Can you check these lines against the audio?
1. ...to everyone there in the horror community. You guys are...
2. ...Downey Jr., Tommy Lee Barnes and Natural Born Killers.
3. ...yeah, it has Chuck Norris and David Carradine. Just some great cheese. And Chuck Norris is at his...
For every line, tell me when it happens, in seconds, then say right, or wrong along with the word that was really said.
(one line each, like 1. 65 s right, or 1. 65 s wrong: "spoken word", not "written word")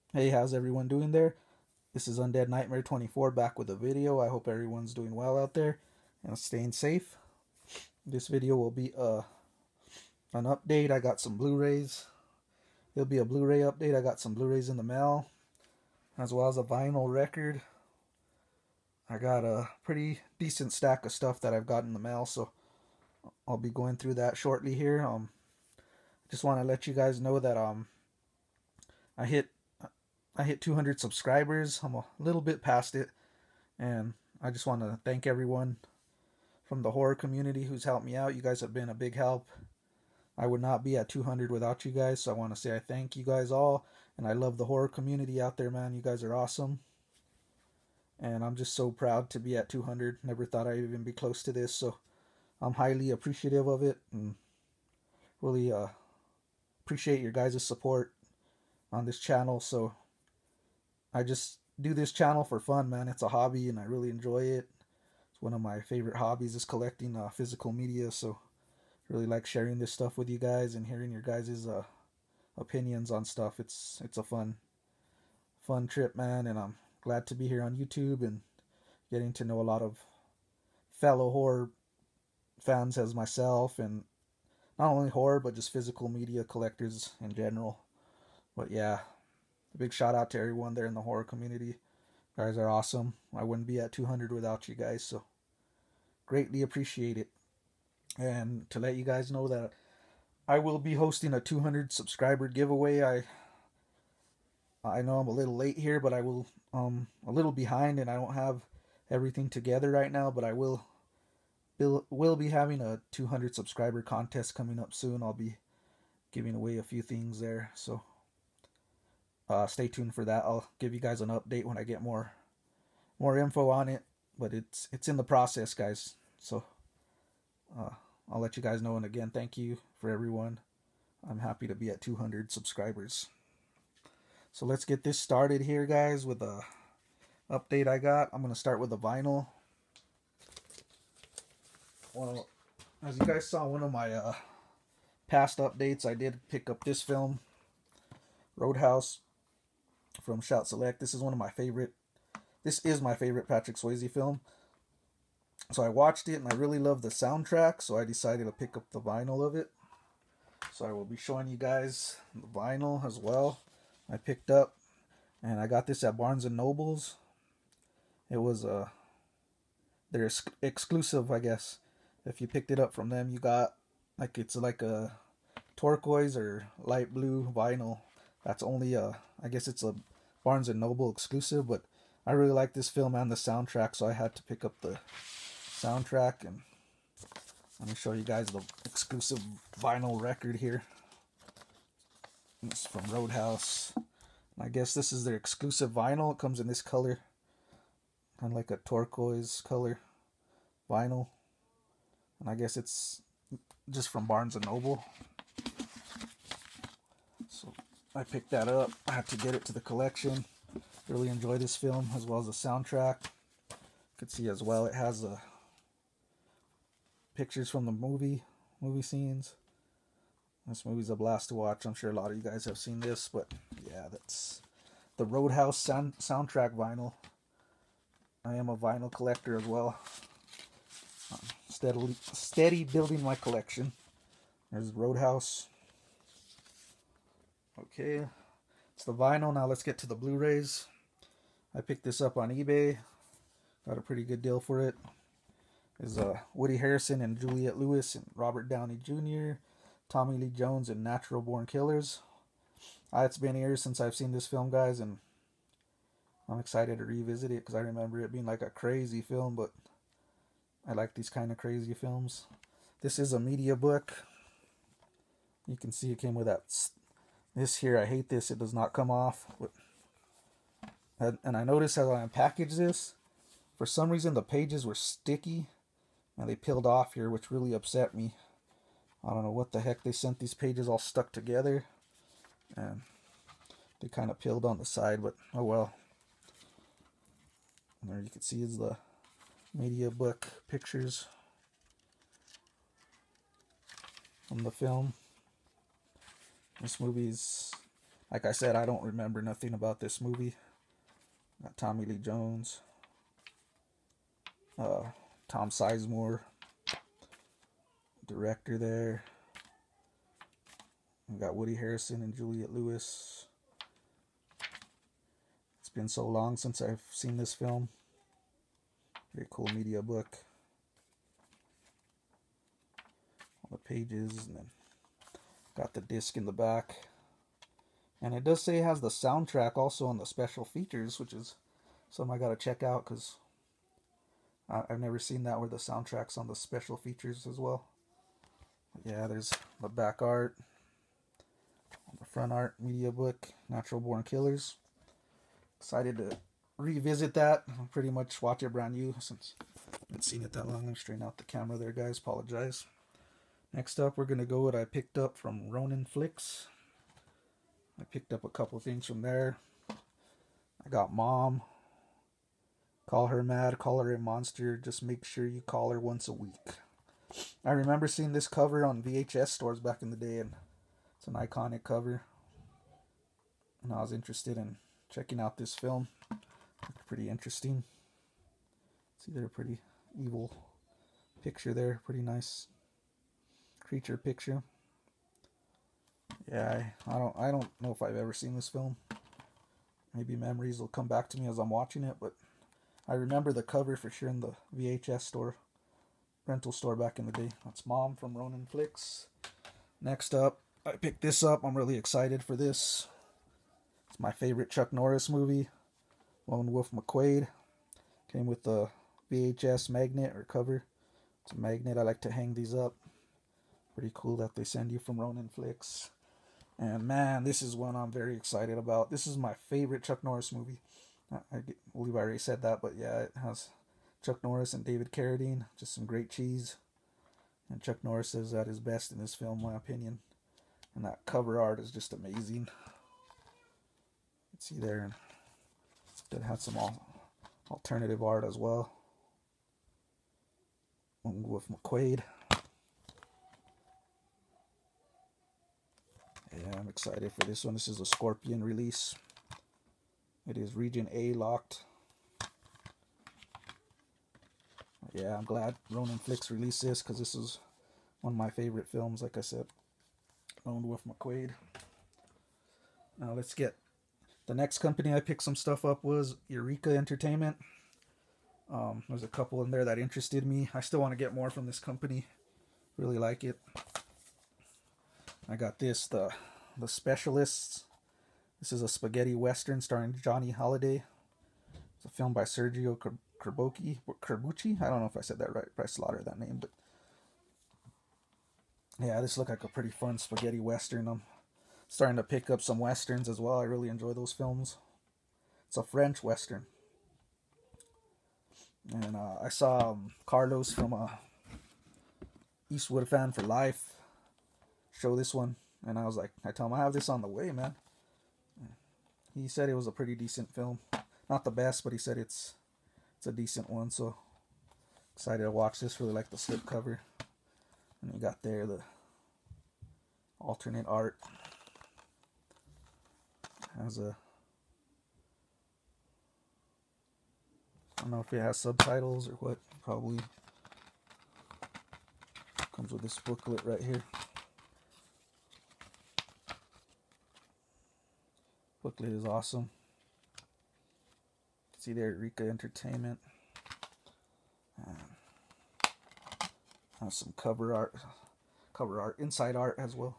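1. 90 s right
2. 248 s wrong: "Jones", not "Barnes"
3. 422 s right.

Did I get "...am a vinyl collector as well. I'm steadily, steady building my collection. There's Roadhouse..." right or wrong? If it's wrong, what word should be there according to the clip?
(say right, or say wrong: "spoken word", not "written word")
right.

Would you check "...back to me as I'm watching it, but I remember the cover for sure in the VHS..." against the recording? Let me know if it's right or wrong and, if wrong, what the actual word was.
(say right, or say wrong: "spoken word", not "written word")
right.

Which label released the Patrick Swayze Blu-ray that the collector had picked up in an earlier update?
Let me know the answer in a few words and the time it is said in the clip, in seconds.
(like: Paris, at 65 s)
Shout Select, at 150 s.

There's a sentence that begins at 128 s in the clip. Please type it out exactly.
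And again, thank you for everyone.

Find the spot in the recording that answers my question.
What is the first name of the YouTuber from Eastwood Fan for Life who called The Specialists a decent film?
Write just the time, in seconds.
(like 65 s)
500 s.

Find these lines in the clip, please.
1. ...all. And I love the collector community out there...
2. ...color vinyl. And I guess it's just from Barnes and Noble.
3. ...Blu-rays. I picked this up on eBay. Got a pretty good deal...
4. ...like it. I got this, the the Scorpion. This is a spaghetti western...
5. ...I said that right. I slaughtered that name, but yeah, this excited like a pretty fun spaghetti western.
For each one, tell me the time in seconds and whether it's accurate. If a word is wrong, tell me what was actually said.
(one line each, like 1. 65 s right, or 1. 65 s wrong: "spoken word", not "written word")
1. 43 s wrong: "horror", not "collector"
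2. 199 s right
3. 240 s right
4. 473 s wrong: "Specialists", not "Scorpion"
5. 485 s wrong: "looked", not "excited".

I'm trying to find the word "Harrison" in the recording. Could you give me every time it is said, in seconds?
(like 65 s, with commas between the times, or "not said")
246 s, 311 s.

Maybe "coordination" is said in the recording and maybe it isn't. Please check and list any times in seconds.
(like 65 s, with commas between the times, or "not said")
not said.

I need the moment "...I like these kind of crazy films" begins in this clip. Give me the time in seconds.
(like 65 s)
260 s.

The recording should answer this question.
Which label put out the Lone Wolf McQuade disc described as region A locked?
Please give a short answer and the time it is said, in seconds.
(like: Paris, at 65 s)
Scorpion, at 448 s.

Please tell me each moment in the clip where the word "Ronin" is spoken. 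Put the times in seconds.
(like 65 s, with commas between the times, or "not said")
355 s, 398 s, 415 s, 455 s.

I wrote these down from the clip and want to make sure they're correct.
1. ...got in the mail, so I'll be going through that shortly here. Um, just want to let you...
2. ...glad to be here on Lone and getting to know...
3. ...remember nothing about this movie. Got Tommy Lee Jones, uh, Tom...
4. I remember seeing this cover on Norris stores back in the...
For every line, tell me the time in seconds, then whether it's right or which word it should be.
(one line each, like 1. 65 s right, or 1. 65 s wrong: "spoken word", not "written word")
1. 21 s right
2. 77 s wrong: "YouTube", not "Lone"
3. 299 s right
4. 367 s wrong: "VHS", not "Norris".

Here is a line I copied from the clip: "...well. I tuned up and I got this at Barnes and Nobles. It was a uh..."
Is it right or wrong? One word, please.
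wrong.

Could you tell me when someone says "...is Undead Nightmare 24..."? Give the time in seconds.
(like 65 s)
2 s.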